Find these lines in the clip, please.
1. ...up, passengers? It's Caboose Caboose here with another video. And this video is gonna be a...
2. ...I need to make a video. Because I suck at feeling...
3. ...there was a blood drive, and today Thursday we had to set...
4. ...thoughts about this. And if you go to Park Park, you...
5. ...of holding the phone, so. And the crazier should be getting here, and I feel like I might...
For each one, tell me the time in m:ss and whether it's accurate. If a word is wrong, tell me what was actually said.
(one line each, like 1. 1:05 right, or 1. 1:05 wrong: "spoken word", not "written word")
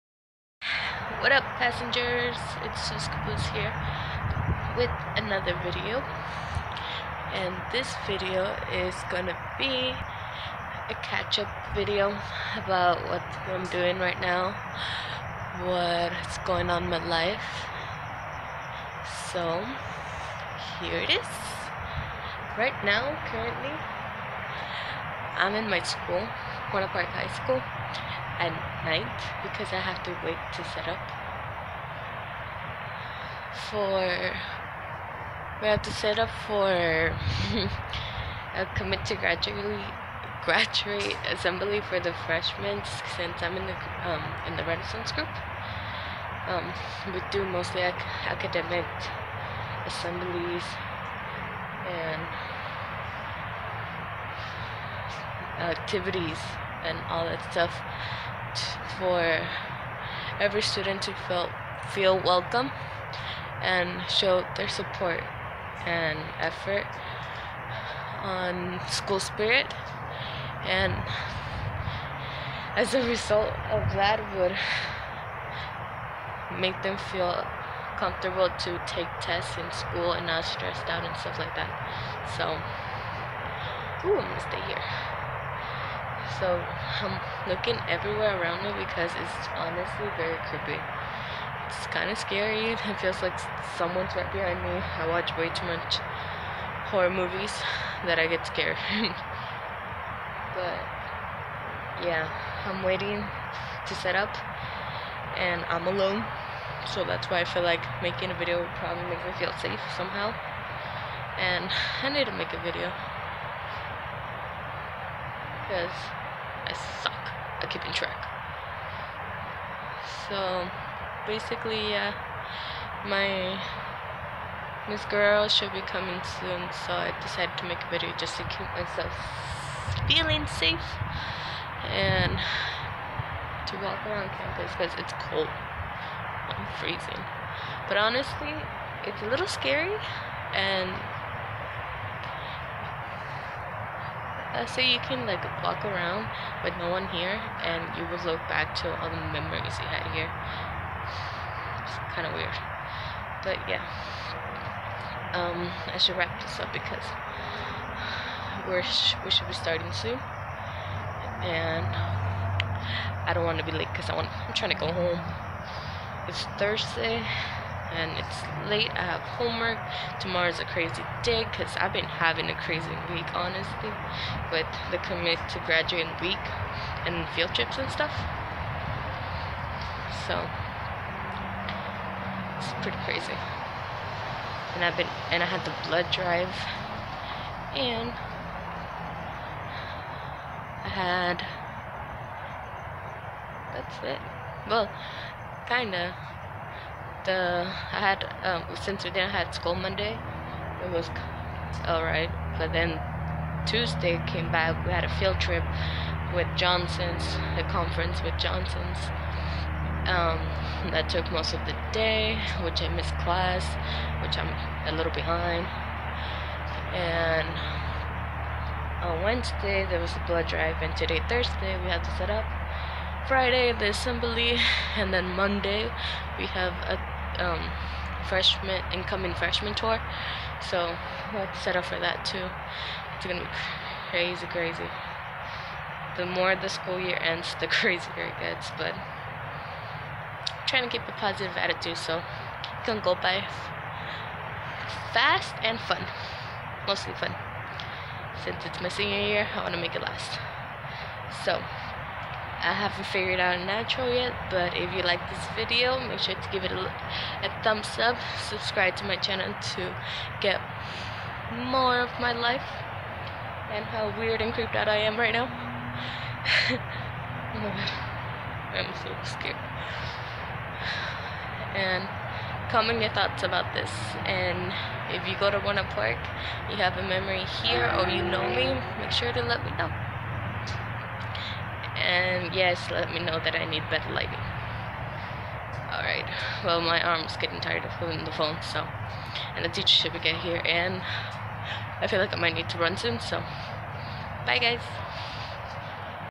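1. 0:01 wrong: "Sus", not "Caboose"
2. 1:52 wrong: "keeping", not "feeling"
3. 3:39 right
4. 4:33 wrong: "Buena", not "Park"
5. 4:47 wrong: "teacher", not "crazier".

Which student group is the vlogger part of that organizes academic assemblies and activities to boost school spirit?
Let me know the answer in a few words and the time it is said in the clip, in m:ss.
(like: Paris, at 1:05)
Renaissance, at 0:44.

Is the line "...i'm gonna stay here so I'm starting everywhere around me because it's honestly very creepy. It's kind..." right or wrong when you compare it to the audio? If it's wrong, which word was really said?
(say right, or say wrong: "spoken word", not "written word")
wrong: "looking", not "starting".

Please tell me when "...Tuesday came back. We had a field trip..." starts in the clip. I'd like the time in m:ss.
3:23.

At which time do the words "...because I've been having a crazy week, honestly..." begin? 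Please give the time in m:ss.
2:51.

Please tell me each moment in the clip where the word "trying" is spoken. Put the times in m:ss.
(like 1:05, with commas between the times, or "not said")
2:44, 4:00.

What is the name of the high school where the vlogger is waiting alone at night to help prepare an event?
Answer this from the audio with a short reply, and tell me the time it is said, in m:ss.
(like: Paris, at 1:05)
Buena Park High School, at 0:26.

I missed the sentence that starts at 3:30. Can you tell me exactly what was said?
Um, that took most of the day, which I missed class, which I'm a little behind.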